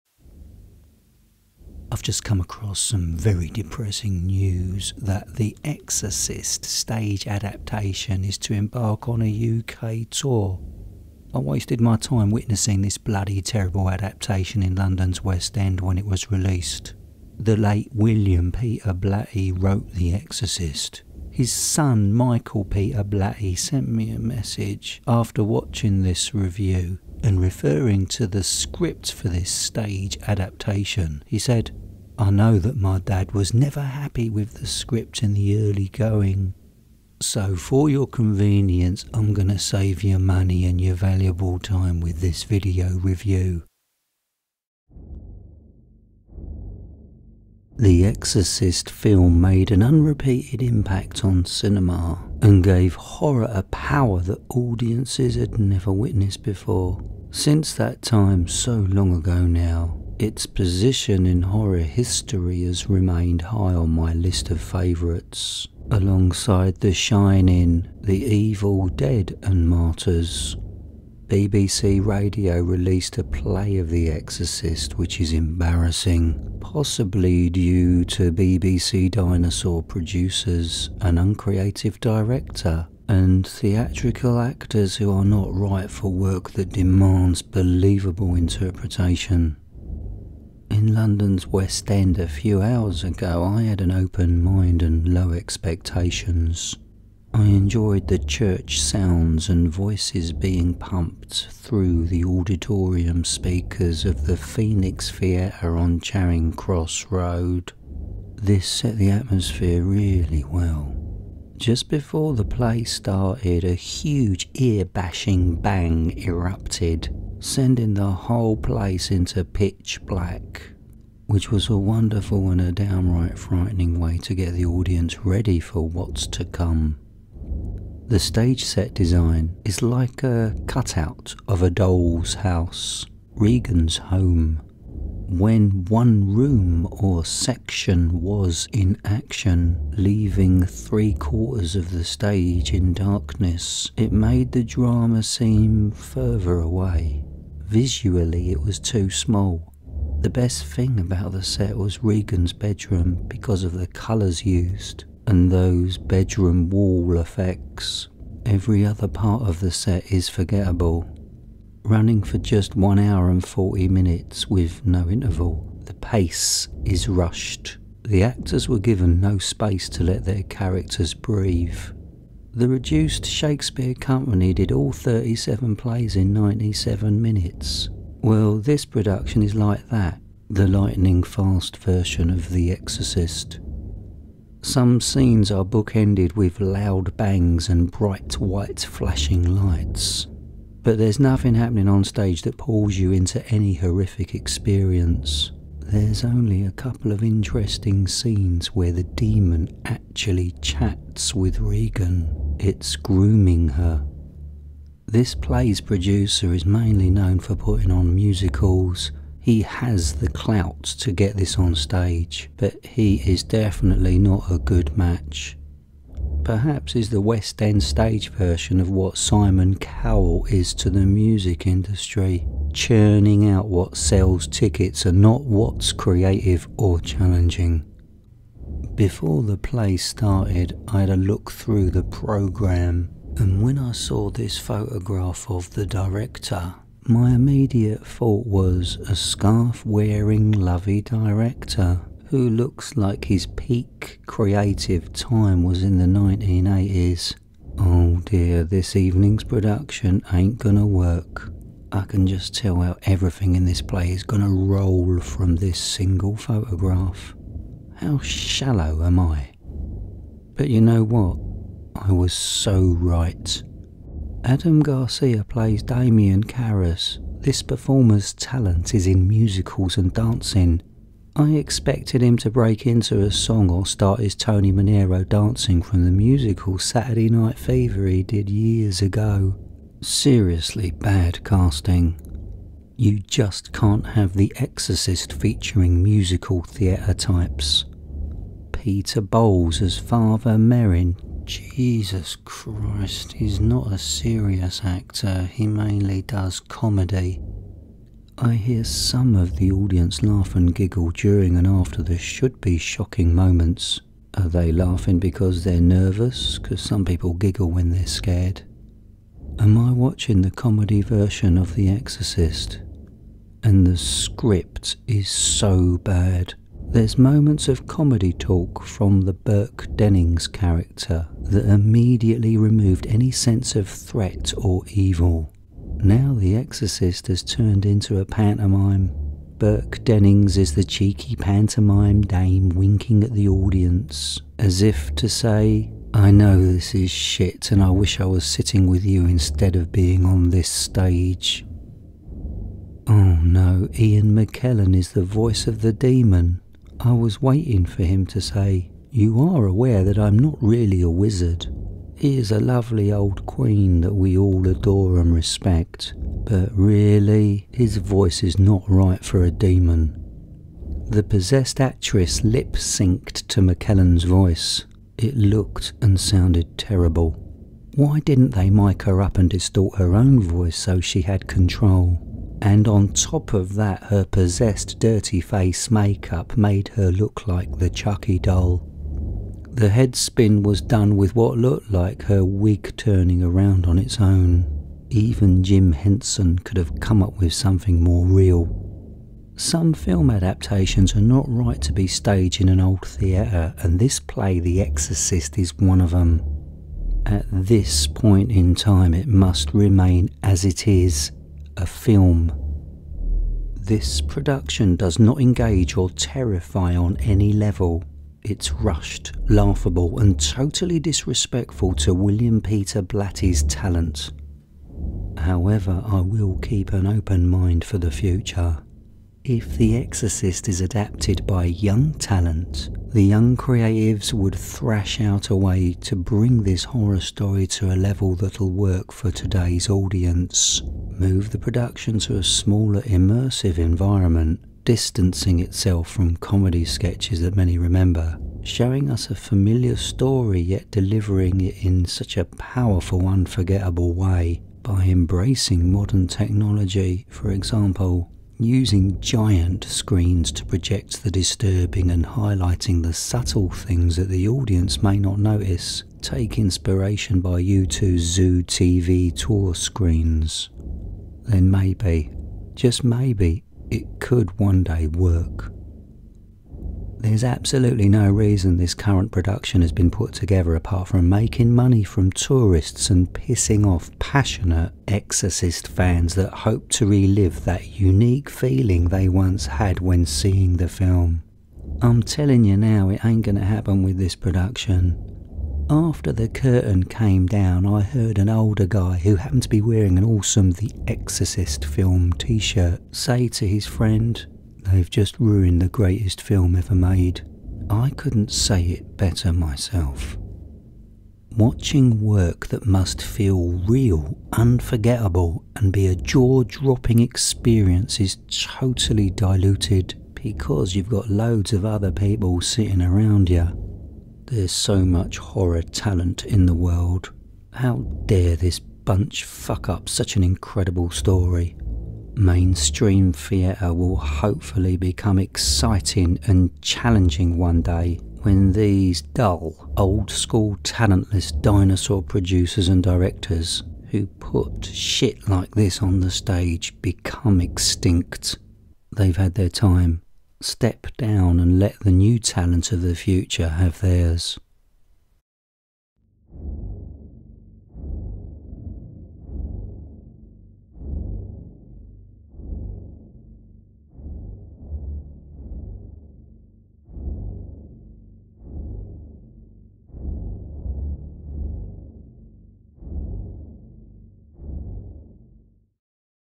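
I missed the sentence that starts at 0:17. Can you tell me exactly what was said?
The late William Peter Blatty wrote The Exorcist.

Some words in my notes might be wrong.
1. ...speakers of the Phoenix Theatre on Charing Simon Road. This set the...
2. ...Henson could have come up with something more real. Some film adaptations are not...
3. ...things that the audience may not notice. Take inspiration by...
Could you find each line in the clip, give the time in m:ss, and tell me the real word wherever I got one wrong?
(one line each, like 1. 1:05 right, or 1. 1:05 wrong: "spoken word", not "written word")
1. 1:43 wrong: "Cross", not "Simon"
2. 6:25 right
3. 7:33 right.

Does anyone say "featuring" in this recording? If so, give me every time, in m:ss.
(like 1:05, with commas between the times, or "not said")
4:45.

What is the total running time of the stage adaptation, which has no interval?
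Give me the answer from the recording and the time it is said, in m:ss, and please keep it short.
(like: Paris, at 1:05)
1 hour and 40 minutes, at 2:42.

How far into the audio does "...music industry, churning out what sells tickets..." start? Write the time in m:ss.
3:41.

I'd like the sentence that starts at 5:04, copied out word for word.
Are they laughing because they're nervous?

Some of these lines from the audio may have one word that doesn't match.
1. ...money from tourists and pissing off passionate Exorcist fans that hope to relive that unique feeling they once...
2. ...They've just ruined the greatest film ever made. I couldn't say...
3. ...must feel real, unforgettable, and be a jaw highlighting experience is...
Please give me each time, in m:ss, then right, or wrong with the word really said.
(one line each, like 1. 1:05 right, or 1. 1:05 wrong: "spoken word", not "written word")
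1. 7:51 right
2. 8:14 right
3. 8:22 wrong: "dropping", not "highlighting".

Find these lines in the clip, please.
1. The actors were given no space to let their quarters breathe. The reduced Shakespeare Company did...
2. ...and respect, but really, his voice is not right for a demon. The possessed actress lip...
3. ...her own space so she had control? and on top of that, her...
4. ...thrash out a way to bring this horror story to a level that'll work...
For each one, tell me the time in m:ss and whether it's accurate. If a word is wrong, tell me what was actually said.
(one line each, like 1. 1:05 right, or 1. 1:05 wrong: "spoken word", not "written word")
1. 2:48 wrong: "characters", not "quarters"
2. 5:55 right
3. 6:09 wrong: "voice", not "space"
4. 7:04 right.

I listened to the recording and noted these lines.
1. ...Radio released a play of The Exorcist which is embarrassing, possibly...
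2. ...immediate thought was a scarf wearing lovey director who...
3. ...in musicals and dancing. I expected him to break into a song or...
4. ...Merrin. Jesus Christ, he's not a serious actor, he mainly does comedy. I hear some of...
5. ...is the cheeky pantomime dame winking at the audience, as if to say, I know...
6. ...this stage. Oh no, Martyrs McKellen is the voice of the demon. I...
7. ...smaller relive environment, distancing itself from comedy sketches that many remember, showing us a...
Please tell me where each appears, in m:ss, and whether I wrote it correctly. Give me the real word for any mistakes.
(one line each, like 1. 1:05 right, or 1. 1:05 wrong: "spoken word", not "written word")
1. 1:12 right
2. 3:57 right
3. 4:29 right
4. 4:50 right
5. 5:30 right
6. 5:40 wrong: "Ian", not "Martyrs"
7. 7:12 wrong: "immersive", not "relive".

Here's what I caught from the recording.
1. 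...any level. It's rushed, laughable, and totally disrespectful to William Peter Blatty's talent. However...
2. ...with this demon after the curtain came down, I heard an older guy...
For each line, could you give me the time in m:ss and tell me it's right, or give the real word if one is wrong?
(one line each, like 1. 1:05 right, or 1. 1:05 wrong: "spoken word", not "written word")
1. 6:47 right
2. 8:04 wrong: "production", not "demon".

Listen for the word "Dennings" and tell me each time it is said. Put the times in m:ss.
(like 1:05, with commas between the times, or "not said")
5:19, 5:30.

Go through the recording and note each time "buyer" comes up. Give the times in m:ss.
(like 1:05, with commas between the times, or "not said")
not said.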